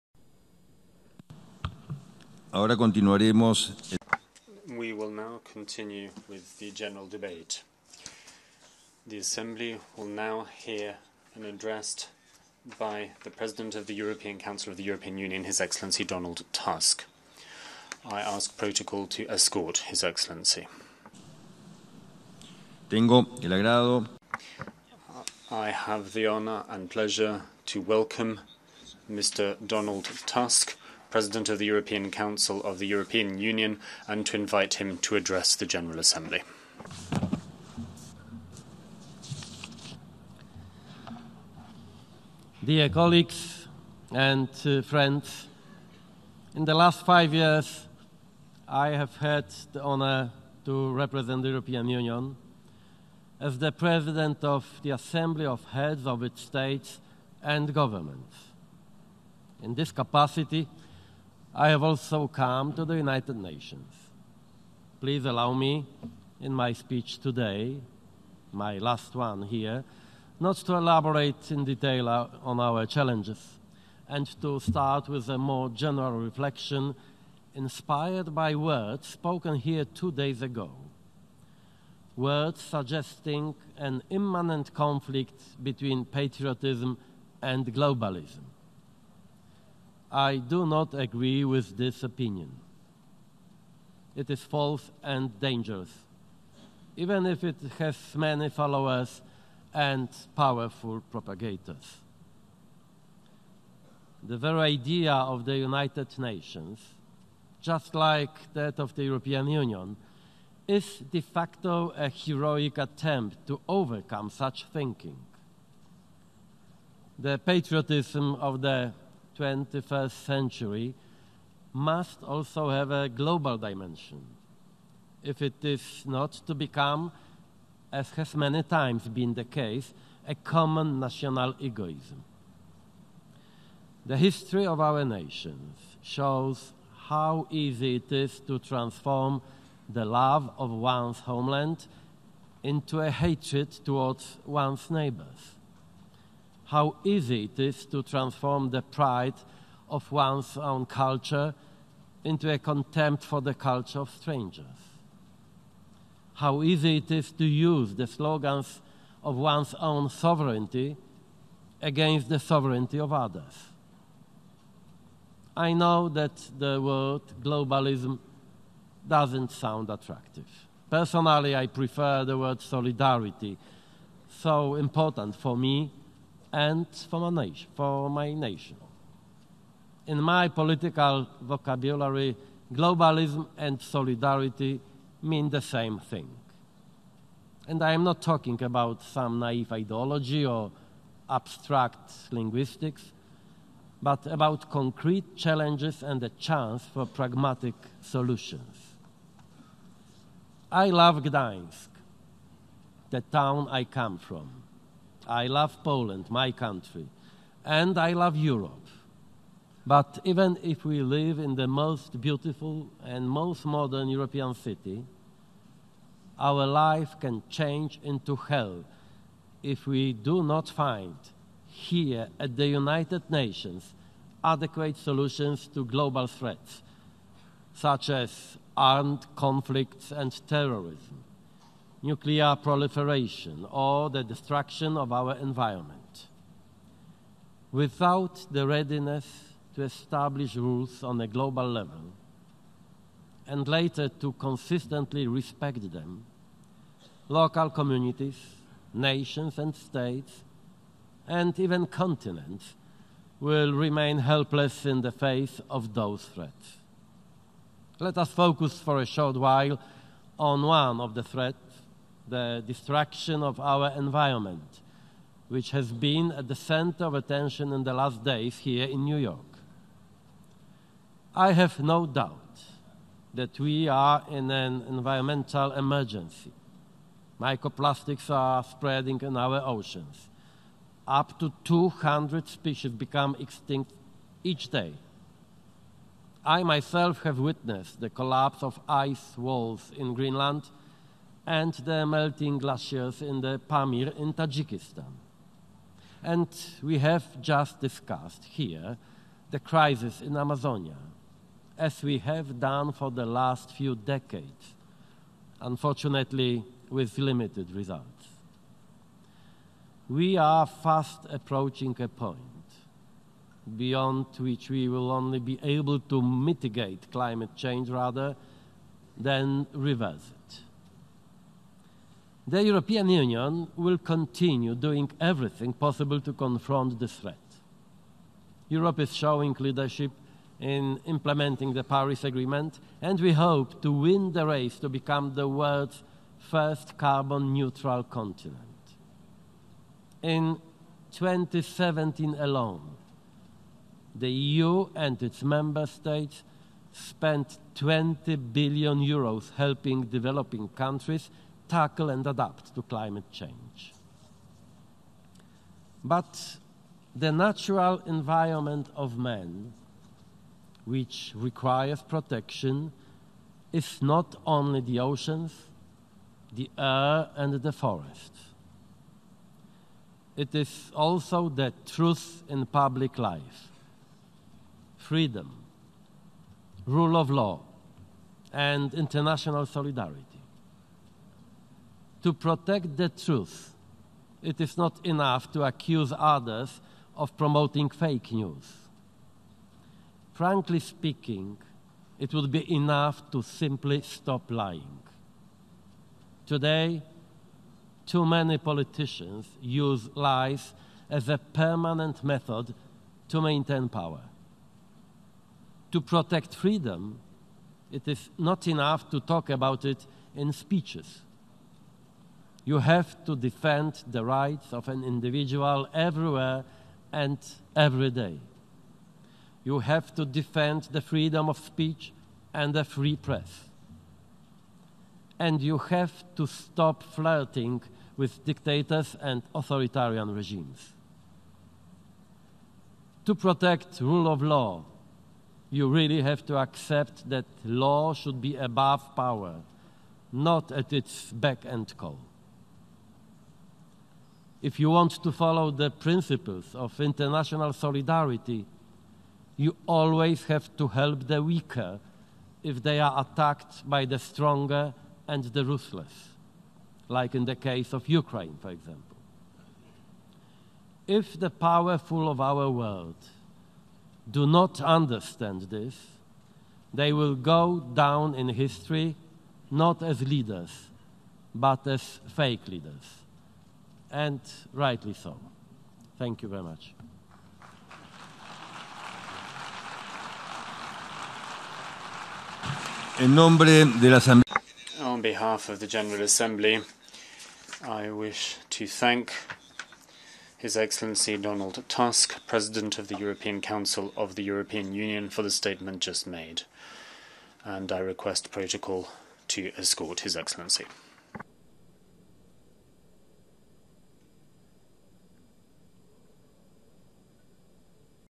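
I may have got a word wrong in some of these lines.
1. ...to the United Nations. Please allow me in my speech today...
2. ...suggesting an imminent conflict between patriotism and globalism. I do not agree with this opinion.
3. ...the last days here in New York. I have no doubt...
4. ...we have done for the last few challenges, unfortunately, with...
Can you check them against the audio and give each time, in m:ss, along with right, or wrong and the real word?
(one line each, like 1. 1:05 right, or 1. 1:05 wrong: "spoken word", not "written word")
1. 1:02 right
2. 1:22 right
3. 4:27 right
4. 5:02 wrong: "decades", not "challenges".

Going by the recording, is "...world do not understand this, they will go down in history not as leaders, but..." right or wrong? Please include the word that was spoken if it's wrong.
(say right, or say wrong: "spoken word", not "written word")
right.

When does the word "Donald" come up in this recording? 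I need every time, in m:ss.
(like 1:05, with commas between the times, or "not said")
0:16, 0:29, 8:11.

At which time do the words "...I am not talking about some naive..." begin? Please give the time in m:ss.
3:07.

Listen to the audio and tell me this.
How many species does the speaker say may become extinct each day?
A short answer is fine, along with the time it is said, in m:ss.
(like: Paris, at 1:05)
Up to 200, at 4:41.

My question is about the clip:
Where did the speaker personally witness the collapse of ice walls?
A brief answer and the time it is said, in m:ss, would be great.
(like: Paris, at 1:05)
Greenland, at 4:50.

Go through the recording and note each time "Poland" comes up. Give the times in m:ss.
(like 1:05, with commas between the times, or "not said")
3:25.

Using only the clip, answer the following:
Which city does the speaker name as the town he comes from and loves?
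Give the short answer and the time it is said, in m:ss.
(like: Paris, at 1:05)
Gdańsk, at 3:21.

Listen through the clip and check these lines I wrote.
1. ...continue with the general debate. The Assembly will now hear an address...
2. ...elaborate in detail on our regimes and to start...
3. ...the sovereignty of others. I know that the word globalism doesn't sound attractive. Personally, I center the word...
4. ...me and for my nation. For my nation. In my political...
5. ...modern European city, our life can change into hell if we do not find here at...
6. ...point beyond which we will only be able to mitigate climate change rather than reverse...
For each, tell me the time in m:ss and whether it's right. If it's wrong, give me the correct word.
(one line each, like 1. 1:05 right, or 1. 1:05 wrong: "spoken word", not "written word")
1. 0:05 right
2. 1:10 wrong: "challenges", not "regimes"
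3. 2:42 wrong: "prefer", not "center"
4. 2:55 right
5. 3:33 right
6. 5:12 right.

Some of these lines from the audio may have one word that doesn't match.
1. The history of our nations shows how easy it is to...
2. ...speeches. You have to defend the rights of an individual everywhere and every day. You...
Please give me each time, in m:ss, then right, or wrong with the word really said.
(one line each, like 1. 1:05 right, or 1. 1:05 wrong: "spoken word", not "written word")
1. 2:14 right
2. 6:50 right.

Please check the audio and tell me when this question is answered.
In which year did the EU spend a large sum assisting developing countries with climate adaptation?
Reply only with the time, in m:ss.
5:41.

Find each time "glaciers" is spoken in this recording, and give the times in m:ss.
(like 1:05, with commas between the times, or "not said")
4:52.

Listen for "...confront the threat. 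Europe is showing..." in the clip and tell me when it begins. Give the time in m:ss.
5:26.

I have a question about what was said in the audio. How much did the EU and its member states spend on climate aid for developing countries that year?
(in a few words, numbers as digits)
20 billion euros.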